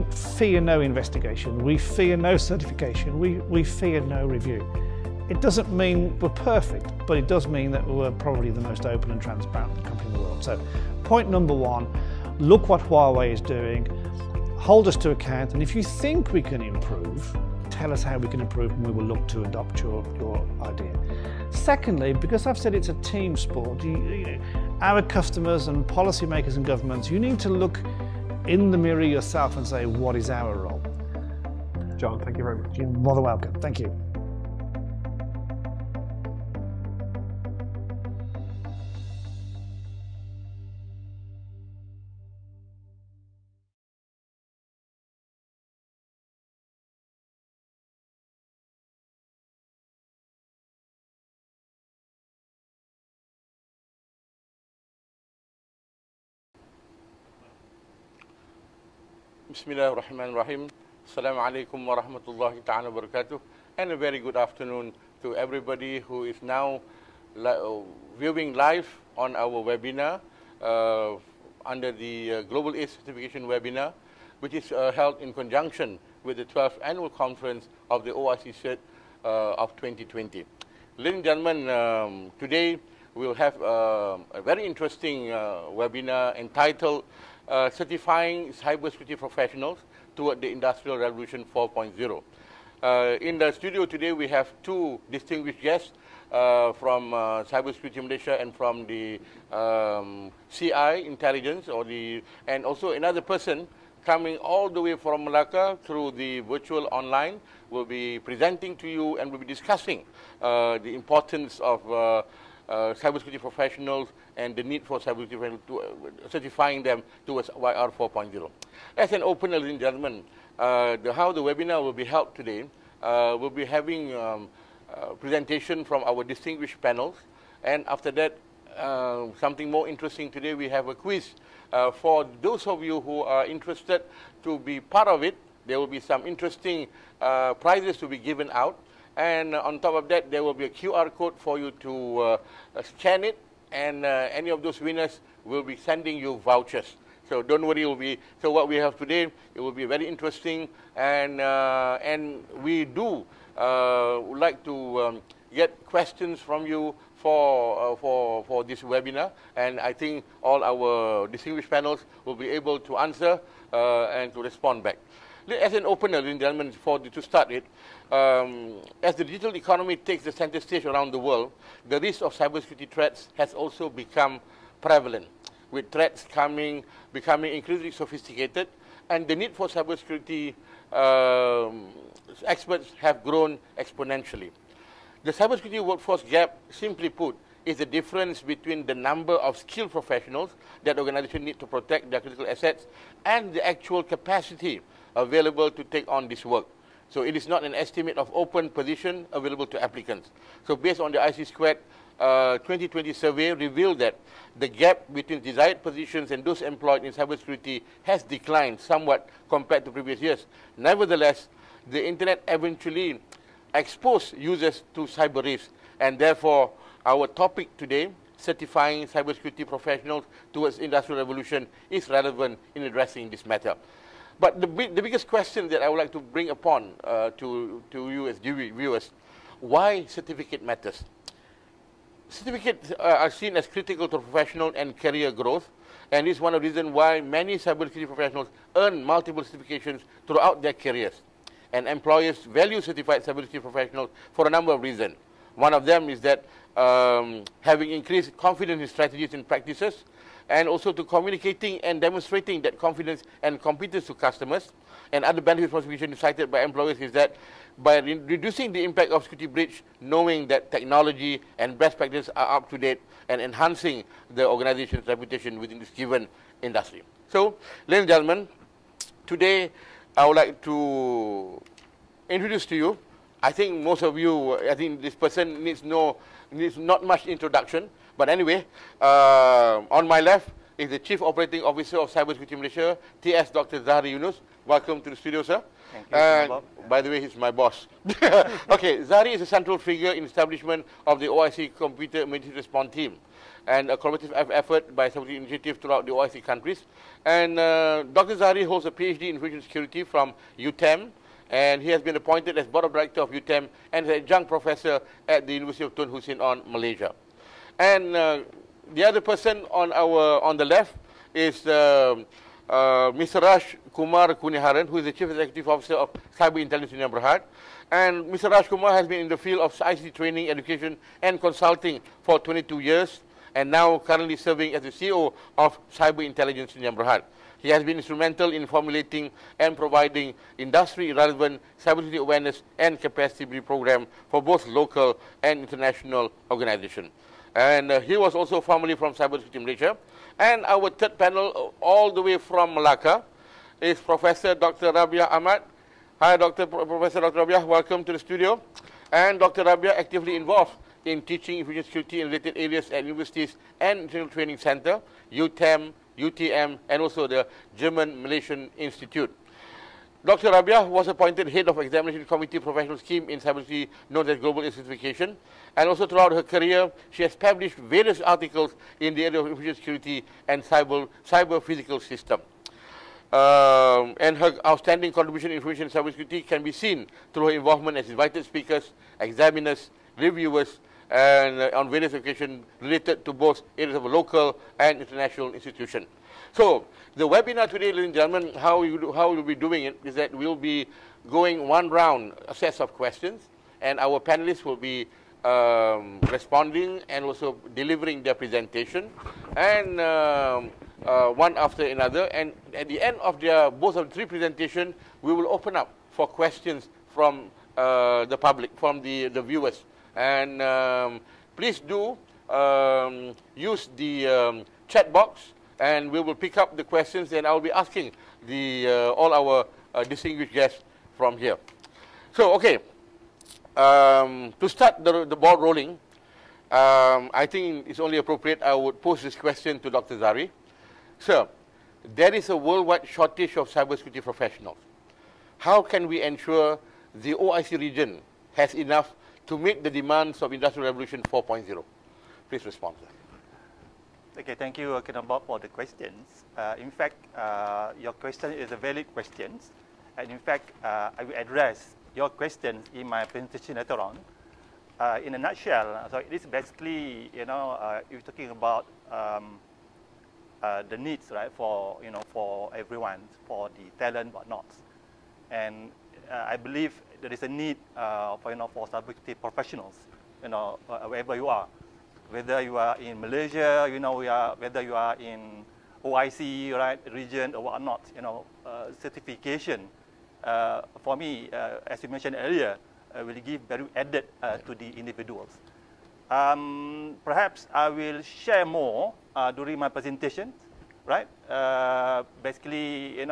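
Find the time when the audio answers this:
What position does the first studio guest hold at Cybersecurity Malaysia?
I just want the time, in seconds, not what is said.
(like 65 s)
280 s.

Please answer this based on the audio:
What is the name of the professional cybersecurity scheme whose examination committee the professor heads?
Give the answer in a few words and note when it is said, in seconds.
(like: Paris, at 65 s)
Global Certification, at 364 s.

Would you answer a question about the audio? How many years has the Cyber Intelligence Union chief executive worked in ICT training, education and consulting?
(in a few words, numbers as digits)
22.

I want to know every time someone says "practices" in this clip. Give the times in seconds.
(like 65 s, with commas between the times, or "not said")
249 s, 261 s.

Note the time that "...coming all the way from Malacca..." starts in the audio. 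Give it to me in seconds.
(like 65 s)
104 s.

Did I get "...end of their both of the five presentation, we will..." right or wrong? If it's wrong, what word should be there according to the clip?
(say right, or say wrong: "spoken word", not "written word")
wrong: "three", not "five".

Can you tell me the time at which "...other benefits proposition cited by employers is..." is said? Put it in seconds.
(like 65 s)
255 s.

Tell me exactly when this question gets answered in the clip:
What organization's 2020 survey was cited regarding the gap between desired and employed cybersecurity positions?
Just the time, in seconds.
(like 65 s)
201 s.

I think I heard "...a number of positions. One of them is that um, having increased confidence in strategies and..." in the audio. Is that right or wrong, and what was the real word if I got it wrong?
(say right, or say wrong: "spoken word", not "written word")
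wrong: "reasons", not "positions".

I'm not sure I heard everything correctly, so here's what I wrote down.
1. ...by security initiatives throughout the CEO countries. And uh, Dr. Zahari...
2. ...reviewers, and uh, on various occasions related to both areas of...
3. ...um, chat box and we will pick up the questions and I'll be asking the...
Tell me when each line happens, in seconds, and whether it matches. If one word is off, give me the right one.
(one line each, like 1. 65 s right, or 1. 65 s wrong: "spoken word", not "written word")
1. 294 s wrong: "OIC", not "CEO"
2. 380 s right
3. 414 s right.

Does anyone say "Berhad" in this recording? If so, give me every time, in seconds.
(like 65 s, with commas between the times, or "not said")
317 s, 326 s.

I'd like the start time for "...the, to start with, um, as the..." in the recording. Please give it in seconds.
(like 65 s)
166 s.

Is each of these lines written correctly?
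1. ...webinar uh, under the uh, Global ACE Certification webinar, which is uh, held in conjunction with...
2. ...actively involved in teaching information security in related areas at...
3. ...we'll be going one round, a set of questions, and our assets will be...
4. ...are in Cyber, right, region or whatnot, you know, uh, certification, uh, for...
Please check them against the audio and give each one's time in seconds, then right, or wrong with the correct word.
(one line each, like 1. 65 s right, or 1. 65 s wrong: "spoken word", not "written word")
1. 69 s right
2. 349 s right
3. 390 s wrong: "panelists", not "assets"
4. 474 s wrong: "OIC", not "Cyber".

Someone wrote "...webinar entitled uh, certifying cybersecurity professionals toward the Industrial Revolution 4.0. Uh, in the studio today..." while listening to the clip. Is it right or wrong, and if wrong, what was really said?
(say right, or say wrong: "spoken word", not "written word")
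right.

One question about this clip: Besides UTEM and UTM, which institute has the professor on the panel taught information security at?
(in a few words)
German Malaysian Institute.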